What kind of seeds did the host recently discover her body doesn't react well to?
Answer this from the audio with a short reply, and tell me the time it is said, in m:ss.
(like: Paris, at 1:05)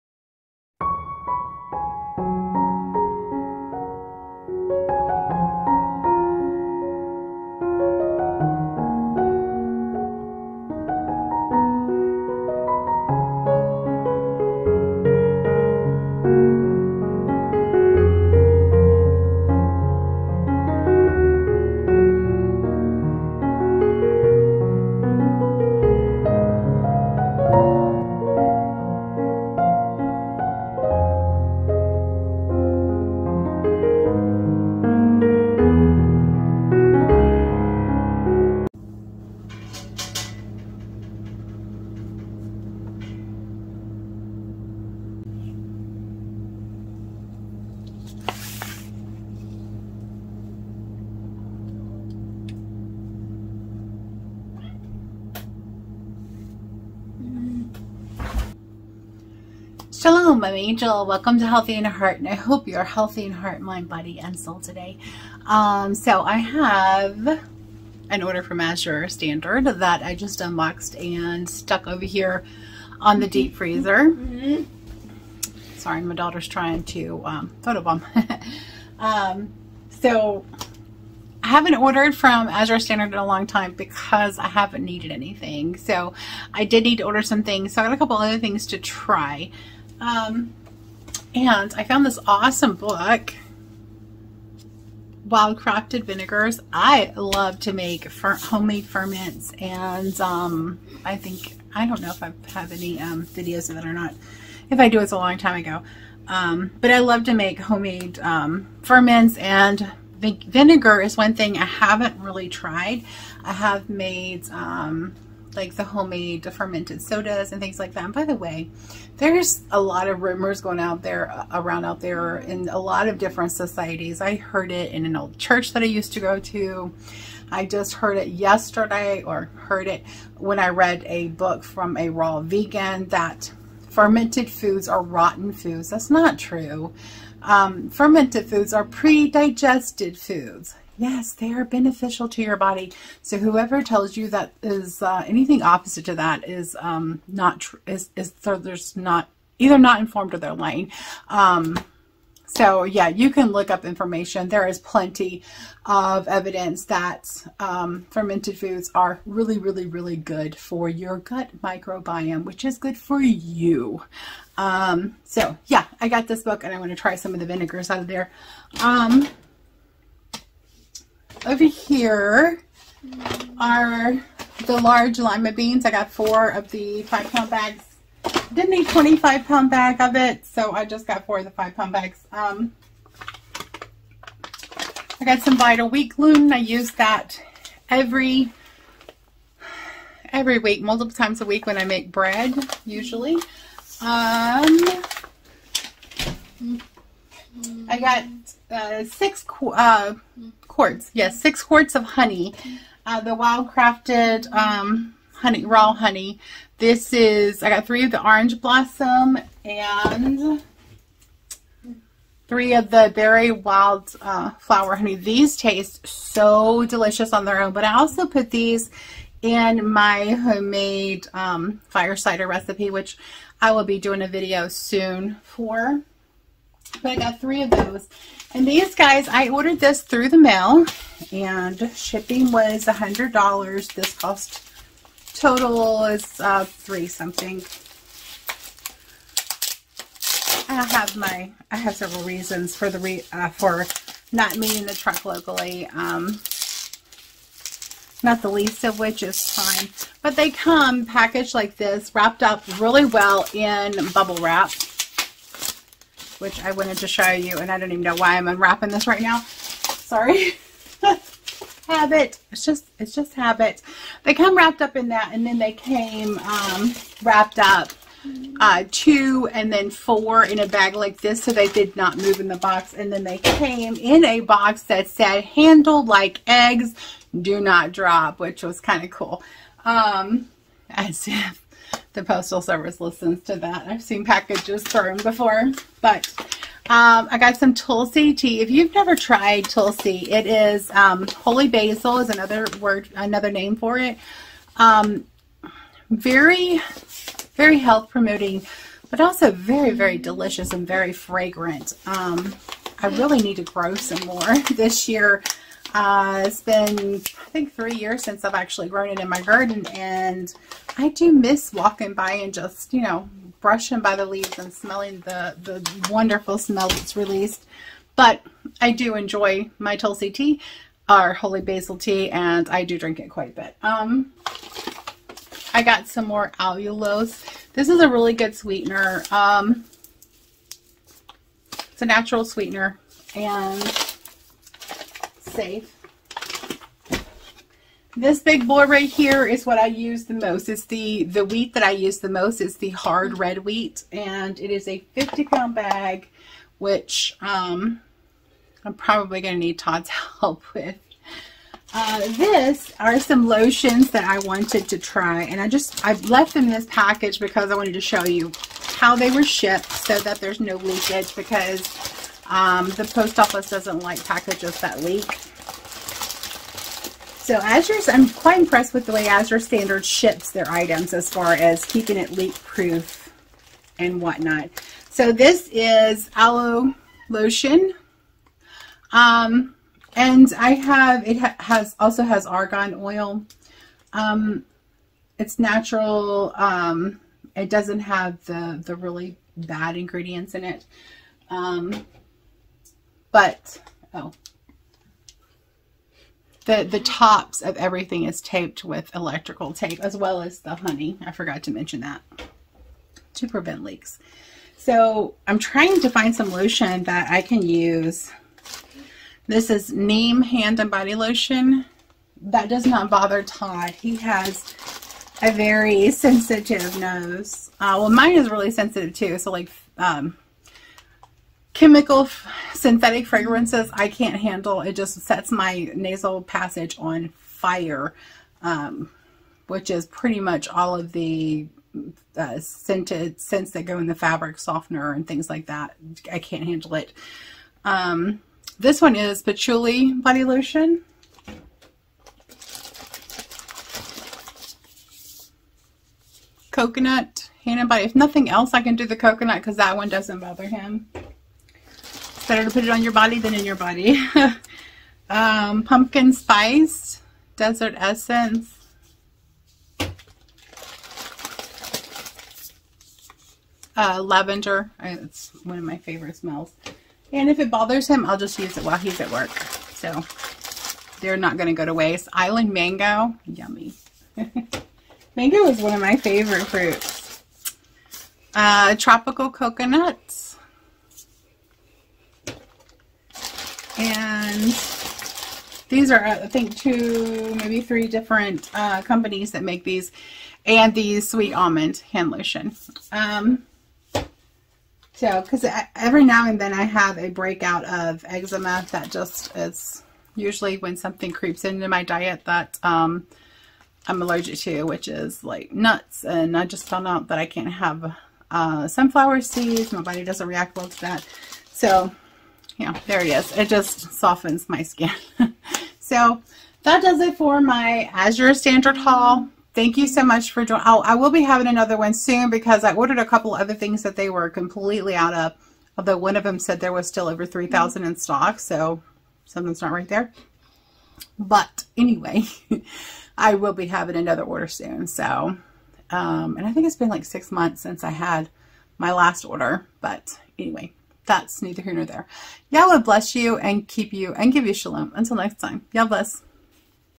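sunflower seeds, at 8:28.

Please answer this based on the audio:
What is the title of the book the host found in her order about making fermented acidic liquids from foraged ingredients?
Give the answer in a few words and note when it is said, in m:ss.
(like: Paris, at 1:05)
Wild Crafted Vinegars, at 1:35.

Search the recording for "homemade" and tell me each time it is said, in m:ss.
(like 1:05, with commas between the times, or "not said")
1:38, 1:47, 1:55, 3:40.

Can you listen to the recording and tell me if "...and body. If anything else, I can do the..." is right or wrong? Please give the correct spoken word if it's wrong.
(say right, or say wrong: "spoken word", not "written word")
wrong: "nothing", not "anything".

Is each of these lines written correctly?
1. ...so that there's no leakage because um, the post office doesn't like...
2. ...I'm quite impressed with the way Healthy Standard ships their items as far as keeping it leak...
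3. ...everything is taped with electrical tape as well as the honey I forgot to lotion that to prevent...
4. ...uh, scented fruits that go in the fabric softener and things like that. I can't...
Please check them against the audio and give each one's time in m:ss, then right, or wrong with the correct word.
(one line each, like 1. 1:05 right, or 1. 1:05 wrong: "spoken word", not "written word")
1. 5:59 right
2. 6:08 wrong: "Azure", not "Healthy"
3. 6:37 wrong: "mention", not "lotion"
4. 7:12 wrong: "scents", not "fruits".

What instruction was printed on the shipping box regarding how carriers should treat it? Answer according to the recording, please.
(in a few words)
Handle like eggs.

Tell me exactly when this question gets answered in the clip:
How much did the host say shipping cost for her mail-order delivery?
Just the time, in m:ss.
3:52.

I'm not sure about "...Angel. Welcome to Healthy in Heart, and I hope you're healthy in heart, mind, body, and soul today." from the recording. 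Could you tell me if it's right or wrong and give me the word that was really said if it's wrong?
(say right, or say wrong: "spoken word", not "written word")
right.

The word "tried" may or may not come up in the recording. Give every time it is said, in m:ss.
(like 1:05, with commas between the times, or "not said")
1:52, 4:49.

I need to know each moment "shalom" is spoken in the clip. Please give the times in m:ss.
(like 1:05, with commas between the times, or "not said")
1:00, 9:04.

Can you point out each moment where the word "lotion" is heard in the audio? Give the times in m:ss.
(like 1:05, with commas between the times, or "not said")
5:53, 6:17, 6:46, 6:51, 7:20, 8:12.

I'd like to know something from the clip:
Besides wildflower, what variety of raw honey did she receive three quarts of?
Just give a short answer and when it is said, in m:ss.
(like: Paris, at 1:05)
orange blossom, at 3:28.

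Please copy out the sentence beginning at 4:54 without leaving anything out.
Um, very, very health promoting, but also very, very delicious and very fragrant.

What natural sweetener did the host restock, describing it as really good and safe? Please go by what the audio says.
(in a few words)
allulose.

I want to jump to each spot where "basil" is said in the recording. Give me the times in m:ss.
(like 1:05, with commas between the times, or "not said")
4:51, 5:21.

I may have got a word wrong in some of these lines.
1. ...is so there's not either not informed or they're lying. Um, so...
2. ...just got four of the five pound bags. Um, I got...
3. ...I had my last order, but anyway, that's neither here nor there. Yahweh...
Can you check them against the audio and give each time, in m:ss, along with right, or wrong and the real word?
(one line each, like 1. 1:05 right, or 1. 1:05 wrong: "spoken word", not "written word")
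1. 2:28 right
2. 3:00 right
3. 8:58 right.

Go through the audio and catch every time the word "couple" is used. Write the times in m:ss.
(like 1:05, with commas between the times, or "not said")
1:28, 8:43.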